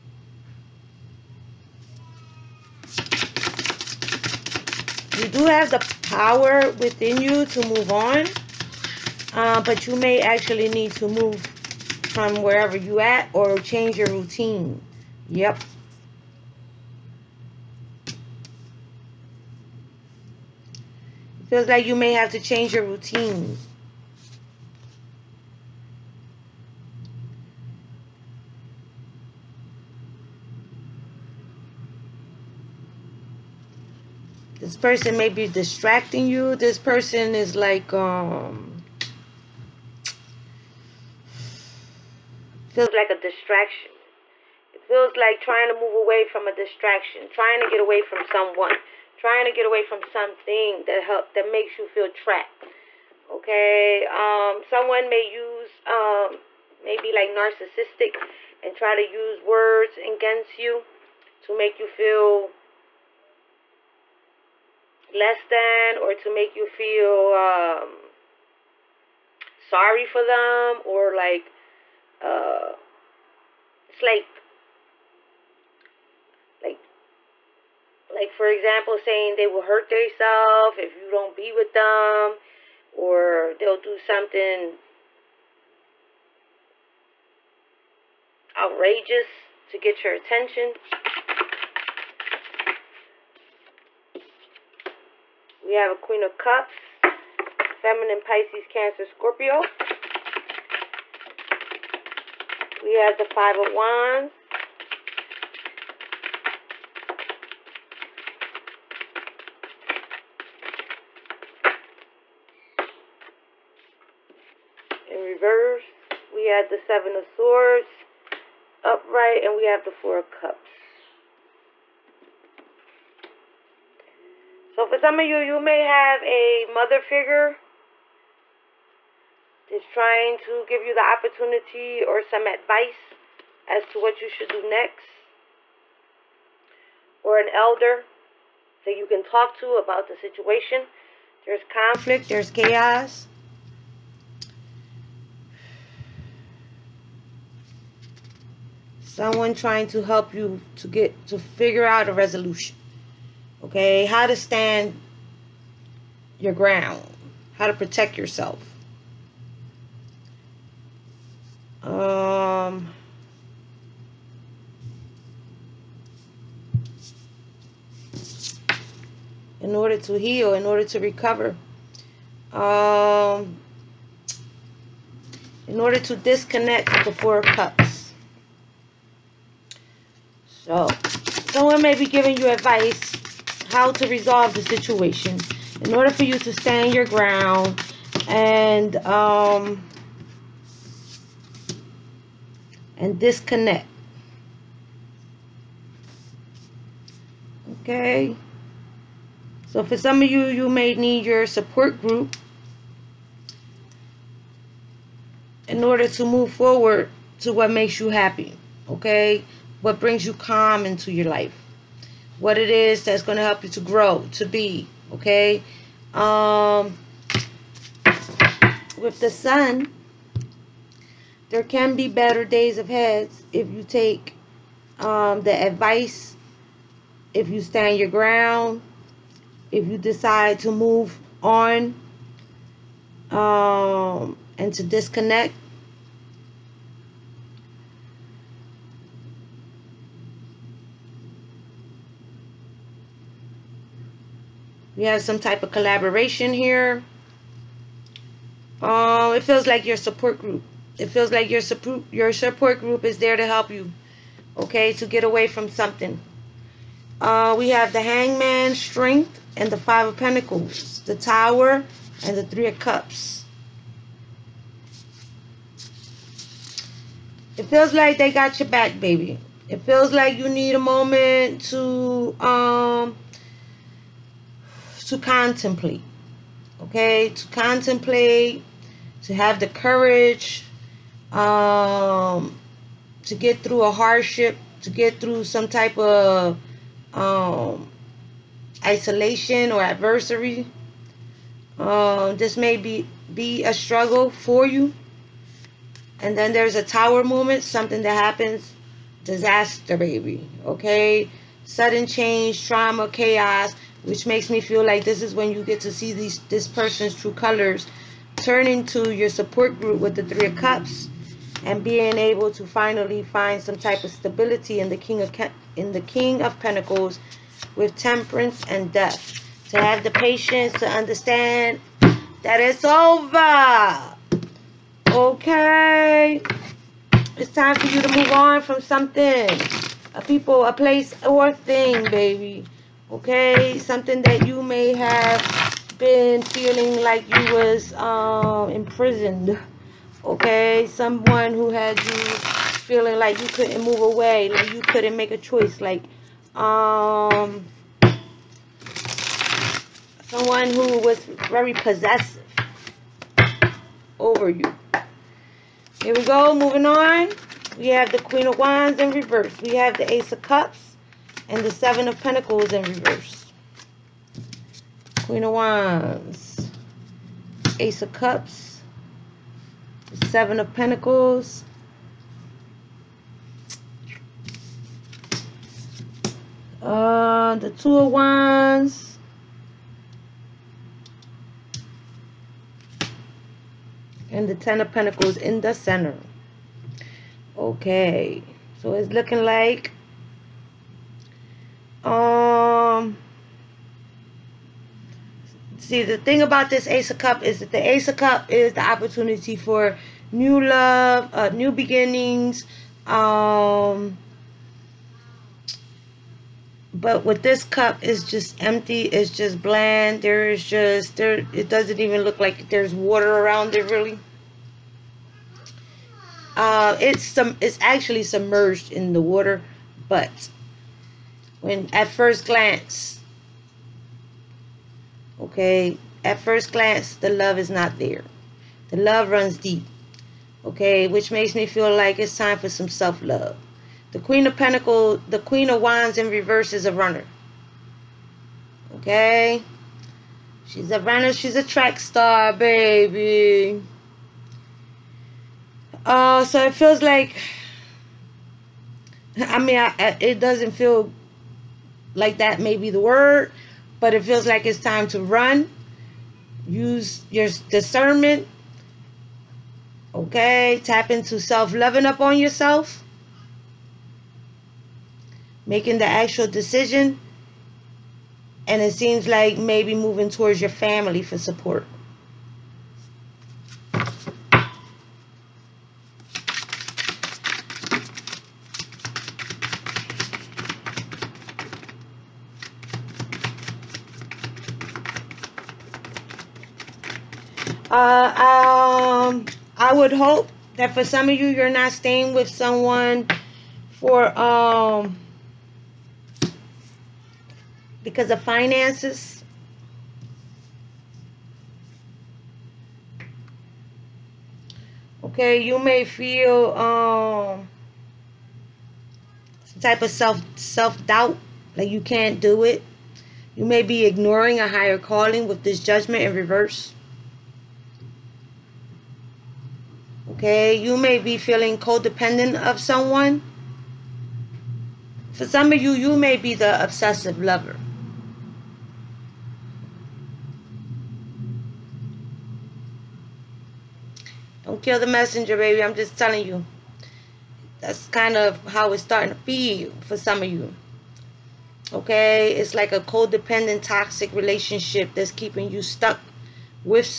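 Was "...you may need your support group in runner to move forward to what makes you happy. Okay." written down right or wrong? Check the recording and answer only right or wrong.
wrong.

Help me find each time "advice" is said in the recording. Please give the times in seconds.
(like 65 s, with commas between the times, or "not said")
132 s, 182 s, 225 s.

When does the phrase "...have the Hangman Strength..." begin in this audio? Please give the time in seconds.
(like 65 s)
257 s.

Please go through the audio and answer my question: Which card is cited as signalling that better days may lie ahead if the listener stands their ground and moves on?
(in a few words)
The Sun.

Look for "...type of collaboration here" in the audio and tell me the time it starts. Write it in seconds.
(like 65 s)
245 s.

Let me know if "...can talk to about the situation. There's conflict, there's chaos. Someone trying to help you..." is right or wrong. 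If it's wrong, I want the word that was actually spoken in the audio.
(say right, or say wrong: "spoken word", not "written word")
right.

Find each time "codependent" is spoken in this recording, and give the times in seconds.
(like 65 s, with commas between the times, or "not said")
521 s, 542 s.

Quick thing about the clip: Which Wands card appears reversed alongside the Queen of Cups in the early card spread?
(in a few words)
Five of Wands.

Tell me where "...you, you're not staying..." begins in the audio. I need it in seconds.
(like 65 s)
491 s.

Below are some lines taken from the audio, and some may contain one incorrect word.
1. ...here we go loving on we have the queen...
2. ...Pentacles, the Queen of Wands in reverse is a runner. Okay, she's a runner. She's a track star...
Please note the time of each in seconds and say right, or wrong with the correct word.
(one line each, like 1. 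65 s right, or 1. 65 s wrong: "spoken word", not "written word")
1. 356 s wrong: "moving", not "loving"
2. 434 s right.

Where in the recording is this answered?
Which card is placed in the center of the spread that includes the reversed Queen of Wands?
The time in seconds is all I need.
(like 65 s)
384 s.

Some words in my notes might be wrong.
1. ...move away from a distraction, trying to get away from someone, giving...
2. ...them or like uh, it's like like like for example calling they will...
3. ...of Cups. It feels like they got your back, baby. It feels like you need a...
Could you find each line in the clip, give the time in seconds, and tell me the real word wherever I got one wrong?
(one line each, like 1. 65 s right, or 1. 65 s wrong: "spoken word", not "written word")
1. 45 s wrong: "trying", not "giving"
2. 70 s wrong: "saying", not "calling"
3. 262 s right.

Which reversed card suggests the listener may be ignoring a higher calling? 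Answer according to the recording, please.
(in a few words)
Judgment.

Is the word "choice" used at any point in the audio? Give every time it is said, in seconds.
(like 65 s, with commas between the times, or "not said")
345 s.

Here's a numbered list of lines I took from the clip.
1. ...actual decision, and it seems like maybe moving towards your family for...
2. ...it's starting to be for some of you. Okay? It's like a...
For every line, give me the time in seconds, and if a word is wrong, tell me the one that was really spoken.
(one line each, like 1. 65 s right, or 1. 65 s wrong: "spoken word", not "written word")
1. 466 s right
2. 538 s right.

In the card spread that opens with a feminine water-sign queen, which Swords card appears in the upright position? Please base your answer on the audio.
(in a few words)
Seven of Swords.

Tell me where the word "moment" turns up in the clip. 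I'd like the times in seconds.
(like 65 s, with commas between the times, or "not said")
270 s, 297 s.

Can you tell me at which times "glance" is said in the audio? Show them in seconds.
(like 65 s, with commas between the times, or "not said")
422 s, 426 s.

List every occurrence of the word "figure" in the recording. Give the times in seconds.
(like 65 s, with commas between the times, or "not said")
127 s, 151 s.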